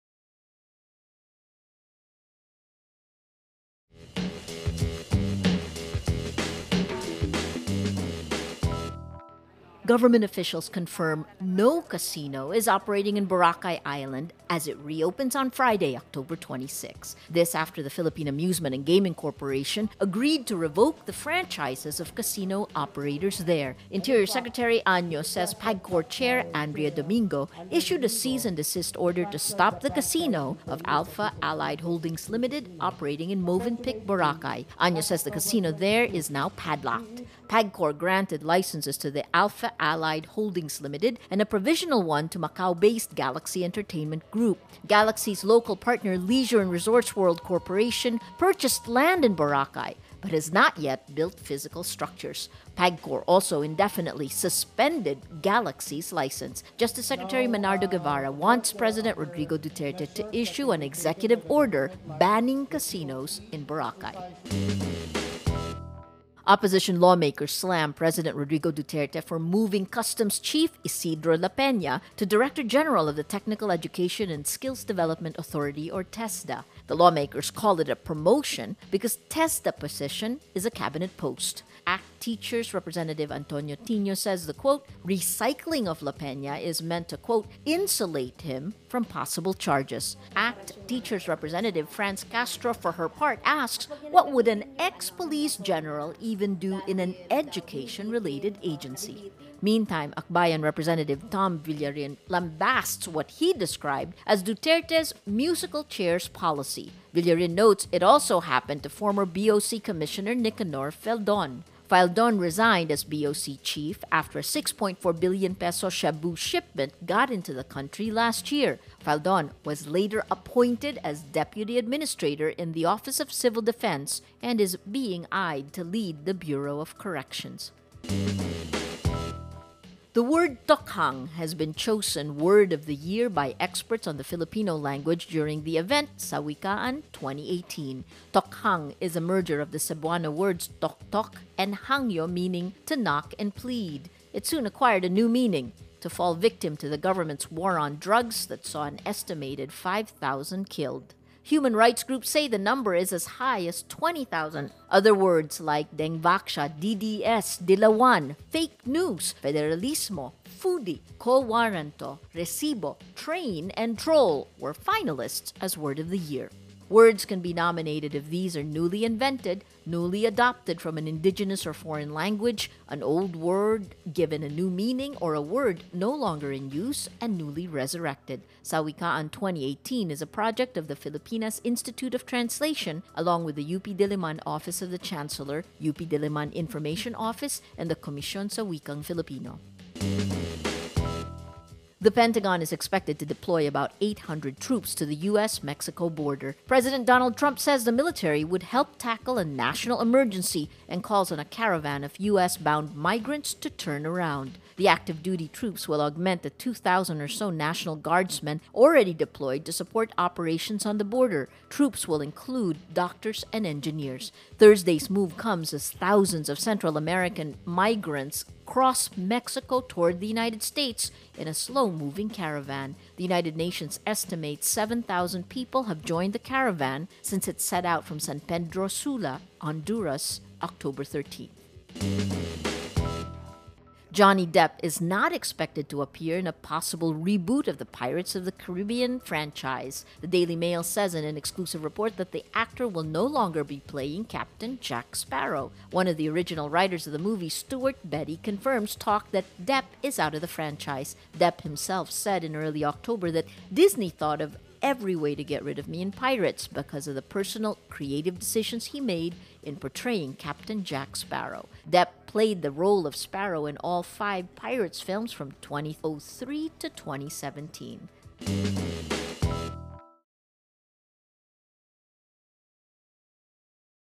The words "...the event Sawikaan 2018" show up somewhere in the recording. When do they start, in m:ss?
2:15.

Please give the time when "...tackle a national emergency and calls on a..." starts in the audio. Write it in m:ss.
3:18.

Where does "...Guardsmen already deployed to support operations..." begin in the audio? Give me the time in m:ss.
3:27.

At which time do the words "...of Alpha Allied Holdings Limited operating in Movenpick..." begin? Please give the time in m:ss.
0:30.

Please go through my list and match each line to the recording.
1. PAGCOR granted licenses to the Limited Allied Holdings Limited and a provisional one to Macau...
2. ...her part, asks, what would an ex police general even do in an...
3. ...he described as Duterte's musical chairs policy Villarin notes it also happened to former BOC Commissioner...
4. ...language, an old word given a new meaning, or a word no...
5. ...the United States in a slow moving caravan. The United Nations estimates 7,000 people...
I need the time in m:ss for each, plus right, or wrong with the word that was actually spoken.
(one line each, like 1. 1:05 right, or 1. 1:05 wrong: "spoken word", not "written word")
1. 0:37 wrong: "Alpha", not "Limited"
2. 1:32 right
3. 1:43 right
4. 2:52 right
5. 3:40 right.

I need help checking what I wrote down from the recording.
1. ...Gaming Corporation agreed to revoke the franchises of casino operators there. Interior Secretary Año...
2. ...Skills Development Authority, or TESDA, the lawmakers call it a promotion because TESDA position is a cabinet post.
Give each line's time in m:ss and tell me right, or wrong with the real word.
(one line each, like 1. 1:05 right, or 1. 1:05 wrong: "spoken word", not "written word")
1. 0:18 right
2. 1:14 right.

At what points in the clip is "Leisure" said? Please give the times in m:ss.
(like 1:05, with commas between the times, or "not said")
0:46.